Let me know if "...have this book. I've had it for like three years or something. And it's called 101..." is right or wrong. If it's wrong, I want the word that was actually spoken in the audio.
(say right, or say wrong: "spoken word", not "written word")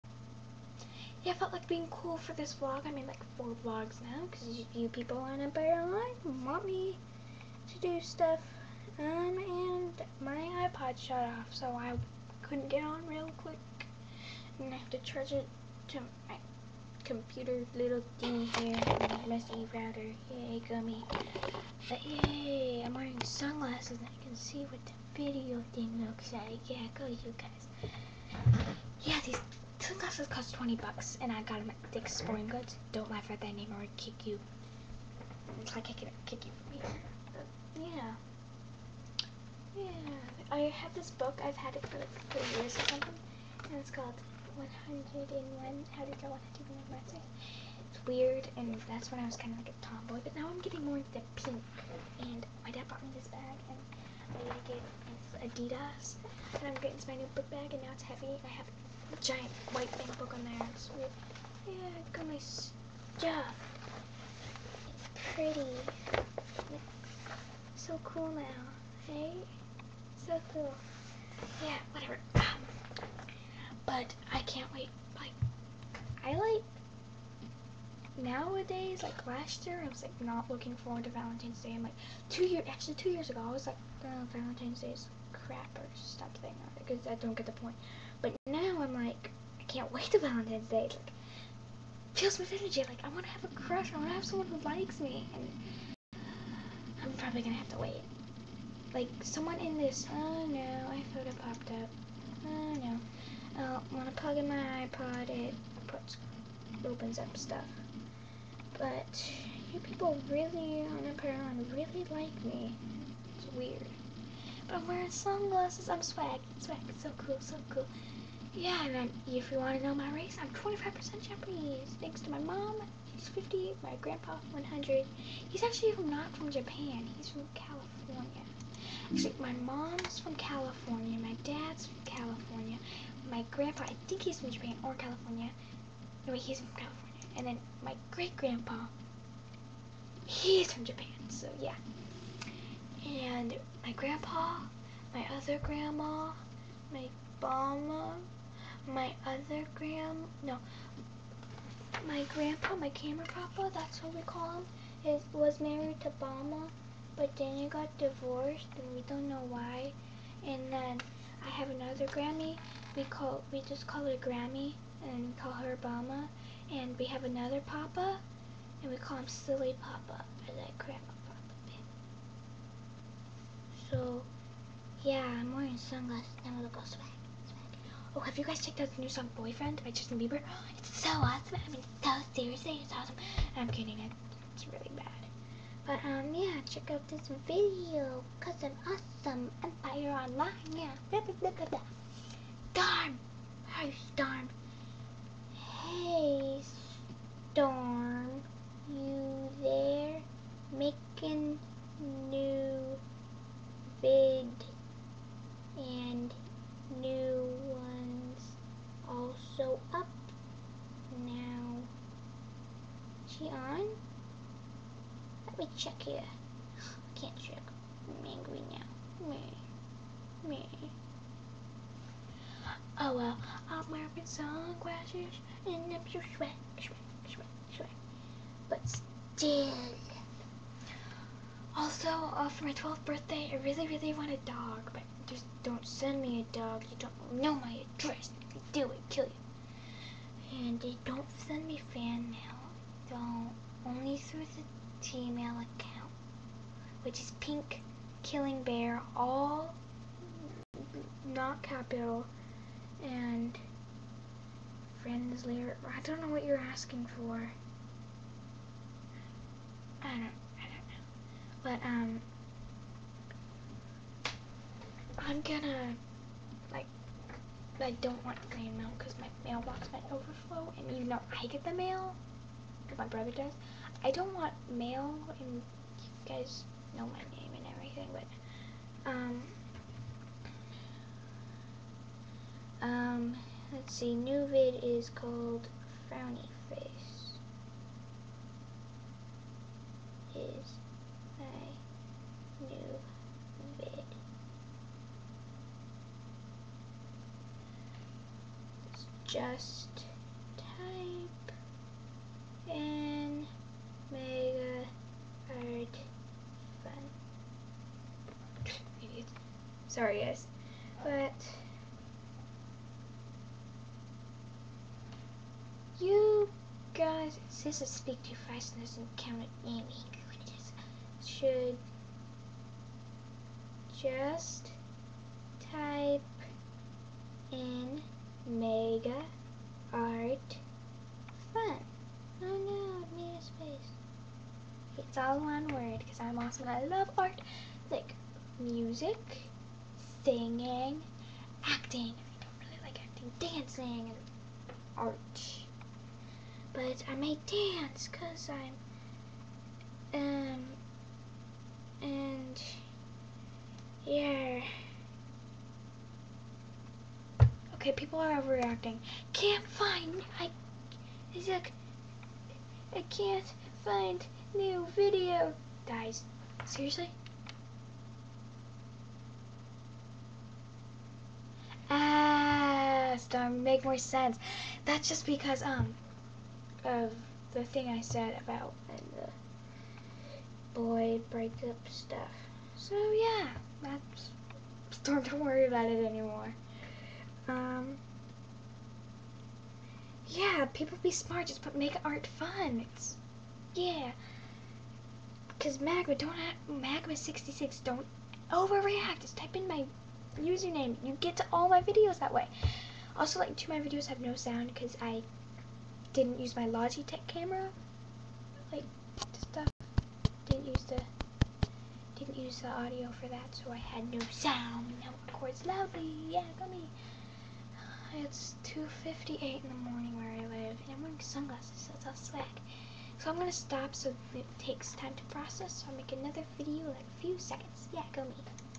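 right.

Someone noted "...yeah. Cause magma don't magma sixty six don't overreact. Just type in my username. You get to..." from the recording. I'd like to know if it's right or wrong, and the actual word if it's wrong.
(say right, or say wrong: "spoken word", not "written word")
right.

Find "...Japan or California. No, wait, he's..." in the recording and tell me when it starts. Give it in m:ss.
2:14.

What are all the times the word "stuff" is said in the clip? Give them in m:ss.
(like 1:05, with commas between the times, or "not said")
0:08, 1:02, 1:47, 6:21, 6:49.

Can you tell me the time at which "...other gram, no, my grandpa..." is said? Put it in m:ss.
2:29.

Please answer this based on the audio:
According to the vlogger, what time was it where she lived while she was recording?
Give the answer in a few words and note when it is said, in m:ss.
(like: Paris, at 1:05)
2:58 in the morning, at 6:58.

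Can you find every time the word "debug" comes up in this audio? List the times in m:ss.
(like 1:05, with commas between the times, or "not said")
not said.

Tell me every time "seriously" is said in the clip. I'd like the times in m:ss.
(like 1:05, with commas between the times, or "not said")
3:02, 6:06.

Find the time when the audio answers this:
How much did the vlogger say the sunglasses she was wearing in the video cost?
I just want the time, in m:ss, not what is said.
0:30.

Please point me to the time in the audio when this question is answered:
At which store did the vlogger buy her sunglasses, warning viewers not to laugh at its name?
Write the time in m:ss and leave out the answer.
0:31.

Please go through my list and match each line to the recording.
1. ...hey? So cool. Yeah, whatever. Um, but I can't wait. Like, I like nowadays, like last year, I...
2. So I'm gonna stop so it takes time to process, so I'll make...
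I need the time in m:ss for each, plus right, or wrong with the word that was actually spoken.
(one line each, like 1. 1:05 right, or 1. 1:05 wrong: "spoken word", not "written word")
1. 1:09 right
2. 7:03 right.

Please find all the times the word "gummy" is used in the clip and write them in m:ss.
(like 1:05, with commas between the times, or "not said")
0:20.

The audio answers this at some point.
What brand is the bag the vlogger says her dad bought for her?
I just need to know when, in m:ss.
0:55.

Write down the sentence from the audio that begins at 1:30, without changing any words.
It's like, fills me with energy.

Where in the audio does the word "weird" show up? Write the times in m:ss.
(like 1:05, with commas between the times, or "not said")
0:48, 1:00, 1:53.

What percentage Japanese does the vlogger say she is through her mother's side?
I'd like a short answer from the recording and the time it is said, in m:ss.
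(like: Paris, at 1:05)
25%, at 2:00.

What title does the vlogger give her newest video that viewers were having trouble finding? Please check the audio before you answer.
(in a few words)
Frowny Face.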